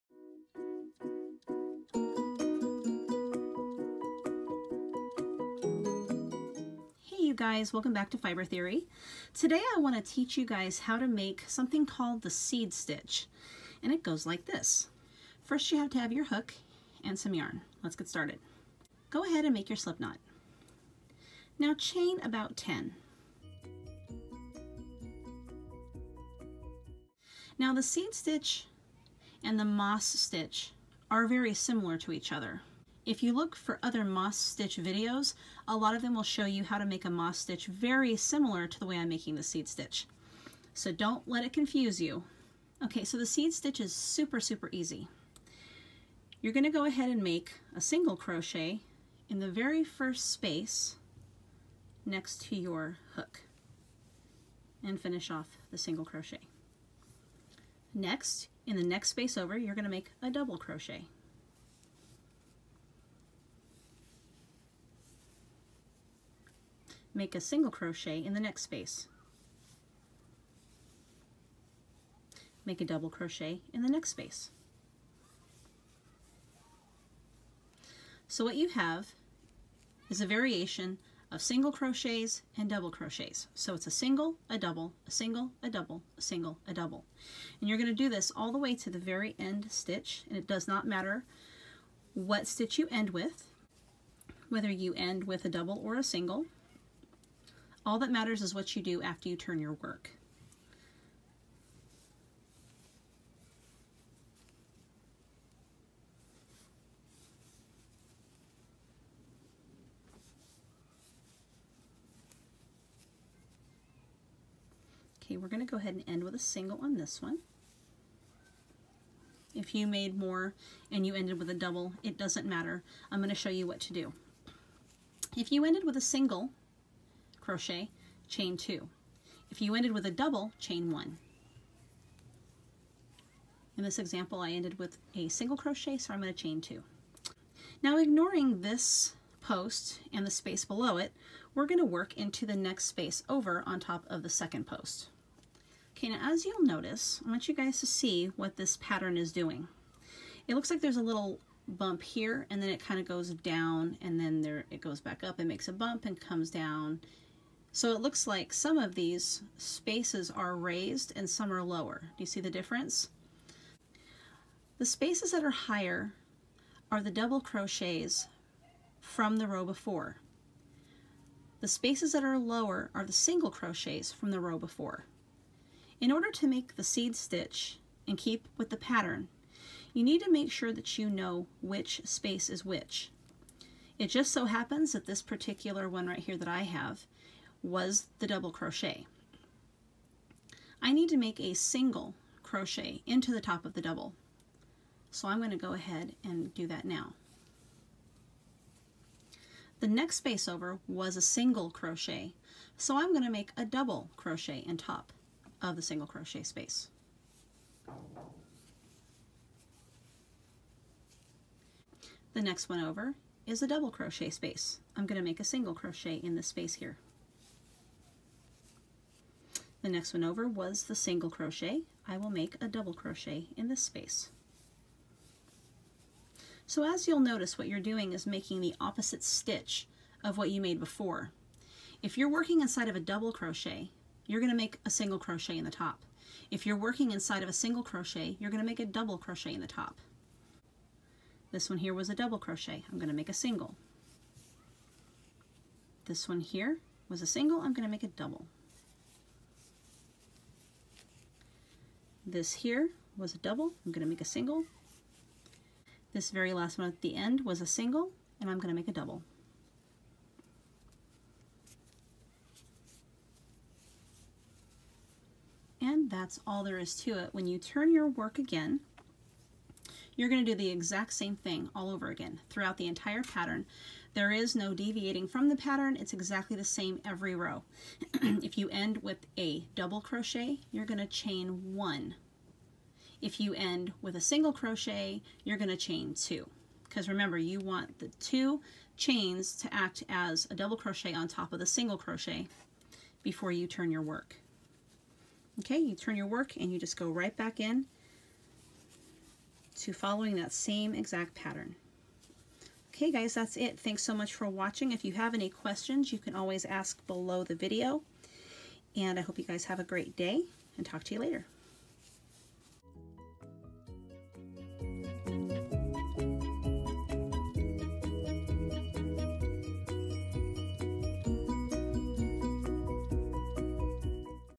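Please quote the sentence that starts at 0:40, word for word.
So don't let it confuse you.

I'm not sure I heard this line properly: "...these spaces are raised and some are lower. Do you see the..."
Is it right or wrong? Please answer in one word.
right.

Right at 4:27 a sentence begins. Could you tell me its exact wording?
When you turn your work again, you're going to do the exact same thing all over again throughout the entire pattern.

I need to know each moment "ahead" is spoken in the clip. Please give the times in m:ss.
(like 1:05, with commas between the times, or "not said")
0:19, 0:46, 1:55, 3:15.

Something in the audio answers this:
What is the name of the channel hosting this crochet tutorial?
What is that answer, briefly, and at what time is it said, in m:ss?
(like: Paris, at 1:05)
Fiber Theory, at 0:08.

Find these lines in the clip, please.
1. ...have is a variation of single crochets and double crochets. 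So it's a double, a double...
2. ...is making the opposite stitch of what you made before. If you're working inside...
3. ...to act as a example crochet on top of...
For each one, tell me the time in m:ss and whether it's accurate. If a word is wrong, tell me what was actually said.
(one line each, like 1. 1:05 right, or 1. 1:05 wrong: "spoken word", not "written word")
1. 1:18 wrong: "single", not "double"
2. 3:48 right
3. 4:49 wrong: "double", not "example".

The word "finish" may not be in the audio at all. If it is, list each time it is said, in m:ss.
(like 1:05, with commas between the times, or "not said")
0:54.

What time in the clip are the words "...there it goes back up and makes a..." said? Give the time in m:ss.
2:34.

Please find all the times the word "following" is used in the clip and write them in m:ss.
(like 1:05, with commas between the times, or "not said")
4:59.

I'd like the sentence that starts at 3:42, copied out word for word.
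I will make a double crochet in this space.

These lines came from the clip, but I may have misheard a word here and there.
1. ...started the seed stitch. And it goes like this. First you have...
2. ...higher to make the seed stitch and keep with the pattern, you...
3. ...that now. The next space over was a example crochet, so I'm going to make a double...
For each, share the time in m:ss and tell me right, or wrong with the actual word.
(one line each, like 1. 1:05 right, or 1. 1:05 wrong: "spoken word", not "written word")
1. 0:11 wrong: "called", not "started"
2. 2:56 wrong: "order", not "higher"
3. 3:16 wrong: "single", not "example".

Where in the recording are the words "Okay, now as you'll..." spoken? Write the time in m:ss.
2:25.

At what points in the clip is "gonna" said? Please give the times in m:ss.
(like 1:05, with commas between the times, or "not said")
0:46, 0:59.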